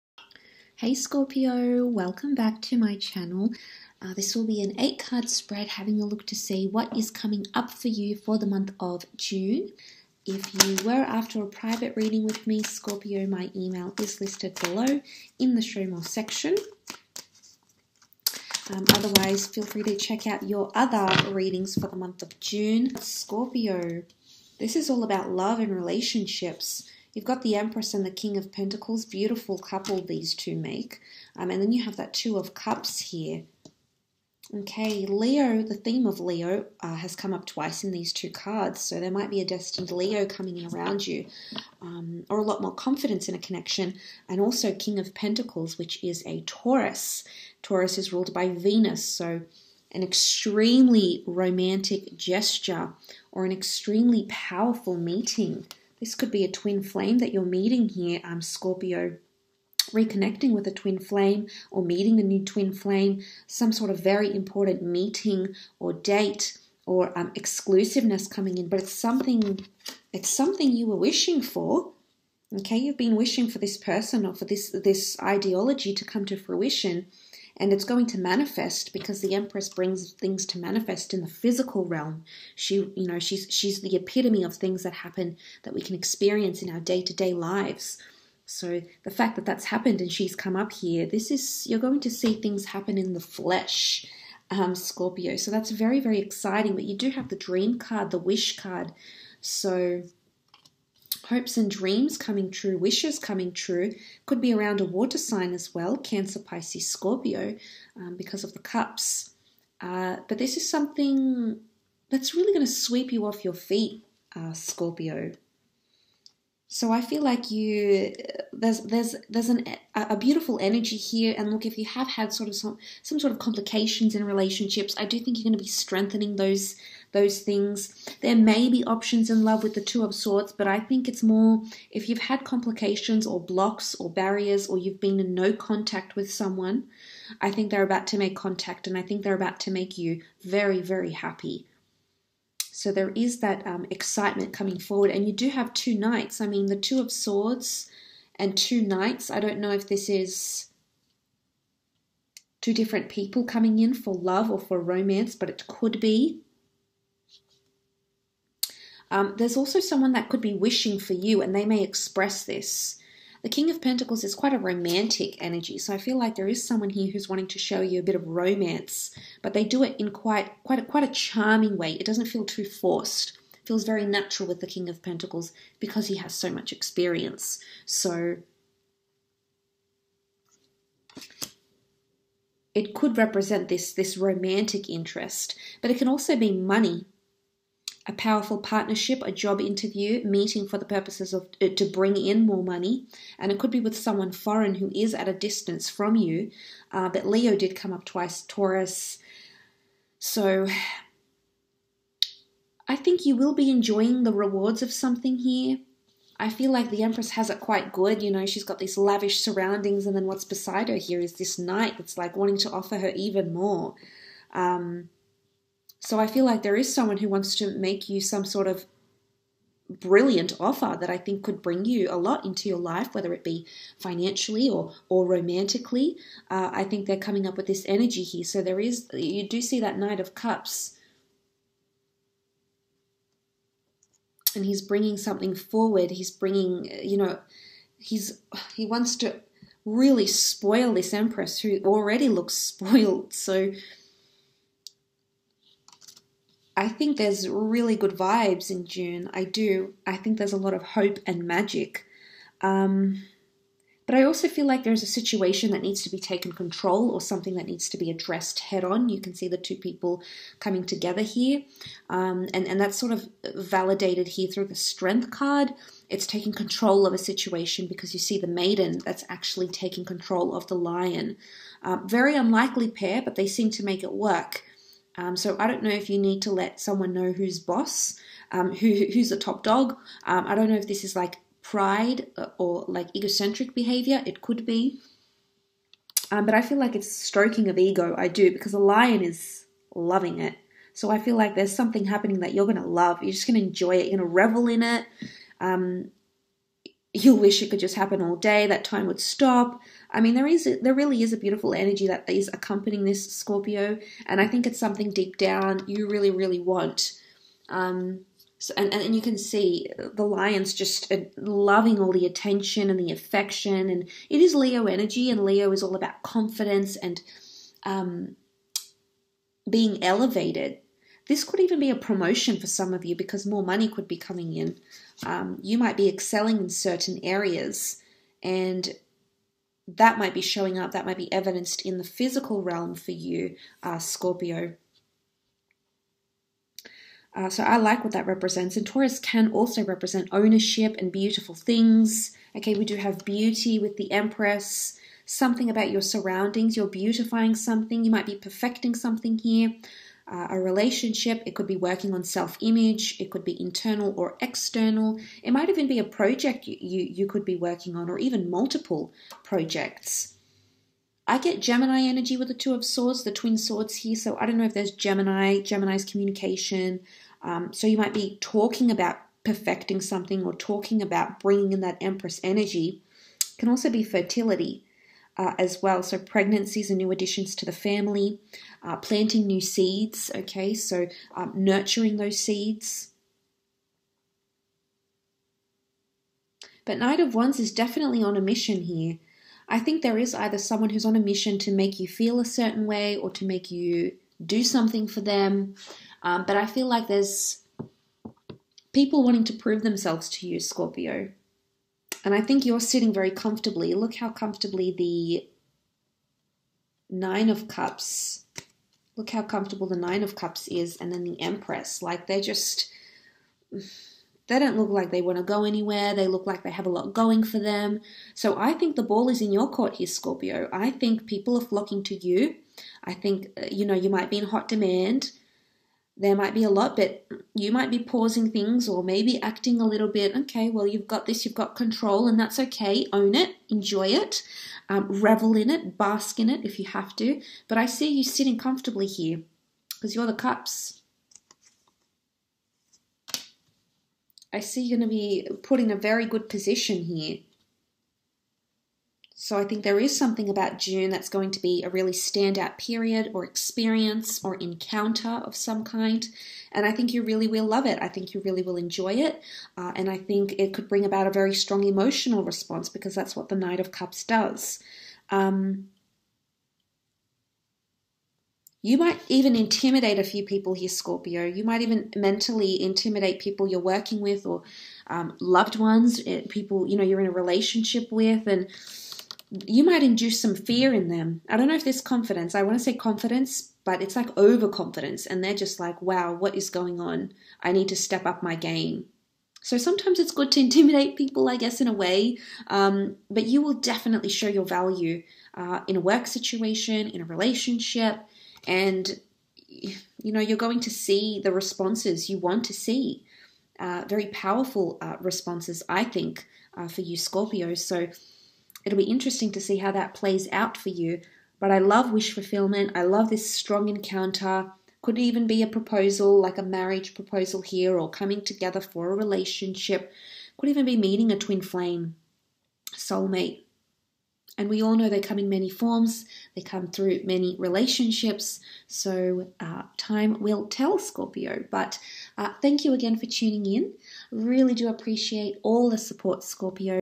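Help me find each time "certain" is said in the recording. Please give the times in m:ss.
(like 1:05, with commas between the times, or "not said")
5:26, 6:32.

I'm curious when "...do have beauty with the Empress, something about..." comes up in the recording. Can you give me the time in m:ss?
5:42.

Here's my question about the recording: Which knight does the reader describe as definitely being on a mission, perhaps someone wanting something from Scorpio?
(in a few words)
Knight of Wands.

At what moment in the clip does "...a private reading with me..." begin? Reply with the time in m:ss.
0:11.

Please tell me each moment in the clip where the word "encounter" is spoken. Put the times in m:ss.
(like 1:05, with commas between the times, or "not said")
7:34, 8:33.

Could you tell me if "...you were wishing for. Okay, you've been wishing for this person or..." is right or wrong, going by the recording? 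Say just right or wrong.
right.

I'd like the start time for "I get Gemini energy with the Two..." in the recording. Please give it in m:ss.
6:01.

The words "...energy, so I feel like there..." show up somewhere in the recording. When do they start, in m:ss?
2:45.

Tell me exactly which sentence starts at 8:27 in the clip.
So it'll be interesting to see how that plays out for you.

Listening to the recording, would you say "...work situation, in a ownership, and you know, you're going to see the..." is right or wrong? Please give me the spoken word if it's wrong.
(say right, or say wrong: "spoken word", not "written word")
wrong: "relationship", not "ownership".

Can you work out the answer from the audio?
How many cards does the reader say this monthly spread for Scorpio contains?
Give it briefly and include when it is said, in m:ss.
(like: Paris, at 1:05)
8, at 0:04.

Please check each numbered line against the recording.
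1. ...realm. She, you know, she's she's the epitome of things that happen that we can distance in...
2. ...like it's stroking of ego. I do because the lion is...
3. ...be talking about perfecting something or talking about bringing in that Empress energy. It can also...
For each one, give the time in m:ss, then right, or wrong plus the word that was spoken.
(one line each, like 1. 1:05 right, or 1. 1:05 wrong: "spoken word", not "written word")
1. 1:21 wrong: "experience", not "distance"
2. 4:46 right
3. 6:08 right.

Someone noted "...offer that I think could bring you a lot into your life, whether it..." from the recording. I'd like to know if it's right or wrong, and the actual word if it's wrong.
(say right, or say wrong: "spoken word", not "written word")
right.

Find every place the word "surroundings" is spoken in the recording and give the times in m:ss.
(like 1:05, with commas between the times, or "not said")
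3:29, 5:46.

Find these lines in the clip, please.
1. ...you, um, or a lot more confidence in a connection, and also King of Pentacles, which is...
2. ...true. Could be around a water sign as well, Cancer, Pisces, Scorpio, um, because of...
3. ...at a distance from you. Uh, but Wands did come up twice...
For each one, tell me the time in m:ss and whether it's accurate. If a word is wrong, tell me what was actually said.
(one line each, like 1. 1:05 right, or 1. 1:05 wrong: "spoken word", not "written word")
1. 0:41 right
2. 1:43 right
3. 3:15 wrong: "Leo", not "Wands".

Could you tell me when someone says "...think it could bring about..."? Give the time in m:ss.
7:40.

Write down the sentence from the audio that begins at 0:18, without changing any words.
Um, otherwise, feel free to check out your other readings for the month of June.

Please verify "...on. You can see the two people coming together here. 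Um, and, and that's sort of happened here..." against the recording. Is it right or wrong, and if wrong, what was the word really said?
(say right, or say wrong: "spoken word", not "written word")
wrong: "validated", not "happened".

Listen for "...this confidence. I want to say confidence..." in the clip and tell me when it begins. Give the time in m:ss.
8:01.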